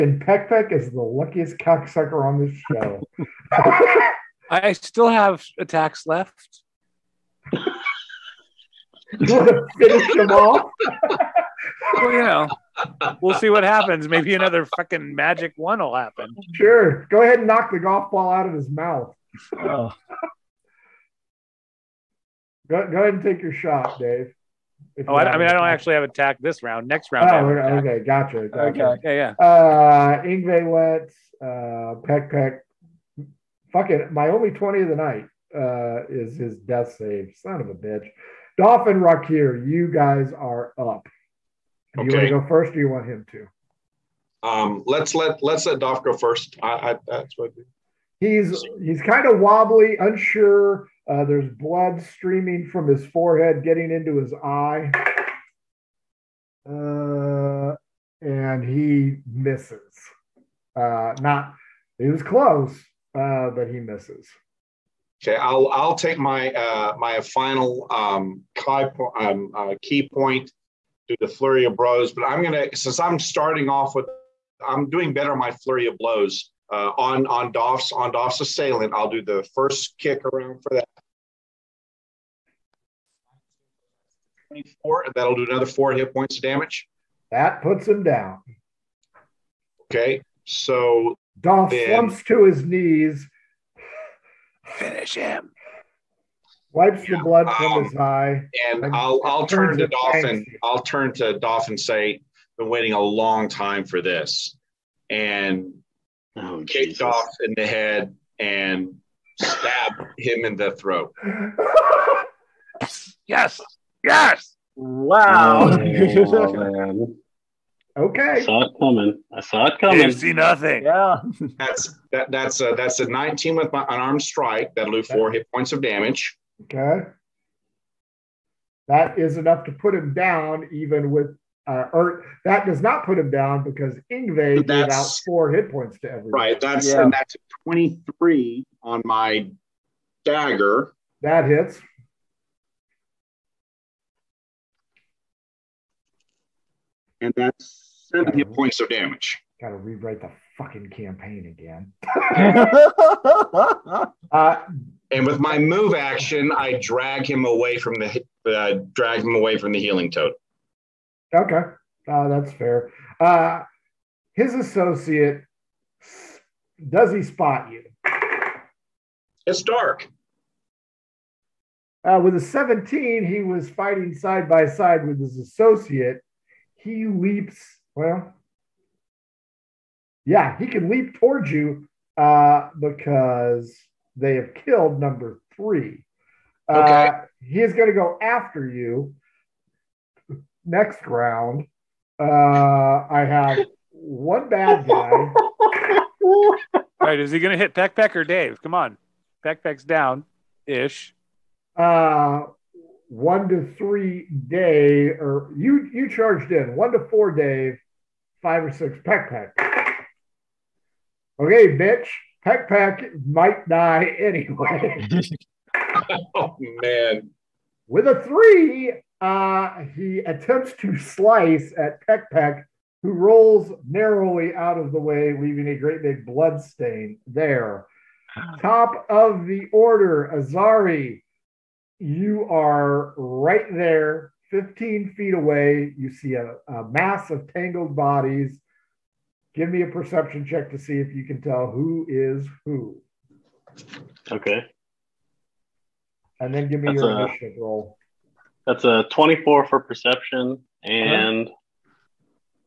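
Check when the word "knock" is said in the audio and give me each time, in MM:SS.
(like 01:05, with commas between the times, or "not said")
00:17.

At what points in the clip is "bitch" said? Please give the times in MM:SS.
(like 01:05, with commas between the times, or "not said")
00:37, 03:31.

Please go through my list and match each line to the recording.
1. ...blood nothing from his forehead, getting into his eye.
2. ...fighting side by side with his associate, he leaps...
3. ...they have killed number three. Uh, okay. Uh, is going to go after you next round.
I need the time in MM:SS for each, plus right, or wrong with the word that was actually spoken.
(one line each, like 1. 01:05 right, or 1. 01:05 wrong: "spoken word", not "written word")
1. 00:51 wrong: "streaming", not "nothing"
2. 02:53 right
3. 03:04 right.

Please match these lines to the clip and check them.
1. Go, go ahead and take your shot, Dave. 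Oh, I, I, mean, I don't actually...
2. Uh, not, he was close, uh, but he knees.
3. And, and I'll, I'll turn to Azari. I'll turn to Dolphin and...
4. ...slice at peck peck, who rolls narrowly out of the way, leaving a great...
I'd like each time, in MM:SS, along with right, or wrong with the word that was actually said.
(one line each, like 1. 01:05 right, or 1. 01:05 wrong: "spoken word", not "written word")
1. 00:22 right
2. 01:00 wrong: "misses", not "knees"
3. 01:38 wrong: "Dolphin", not "Azari"
4. 03:40 right.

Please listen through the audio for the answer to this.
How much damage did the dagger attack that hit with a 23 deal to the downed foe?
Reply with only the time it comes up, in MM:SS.
02:28.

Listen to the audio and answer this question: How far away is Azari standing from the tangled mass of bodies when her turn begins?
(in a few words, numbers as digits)
15 feet.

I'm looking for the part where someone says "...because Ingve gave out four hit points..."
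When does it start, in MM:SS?
02:13.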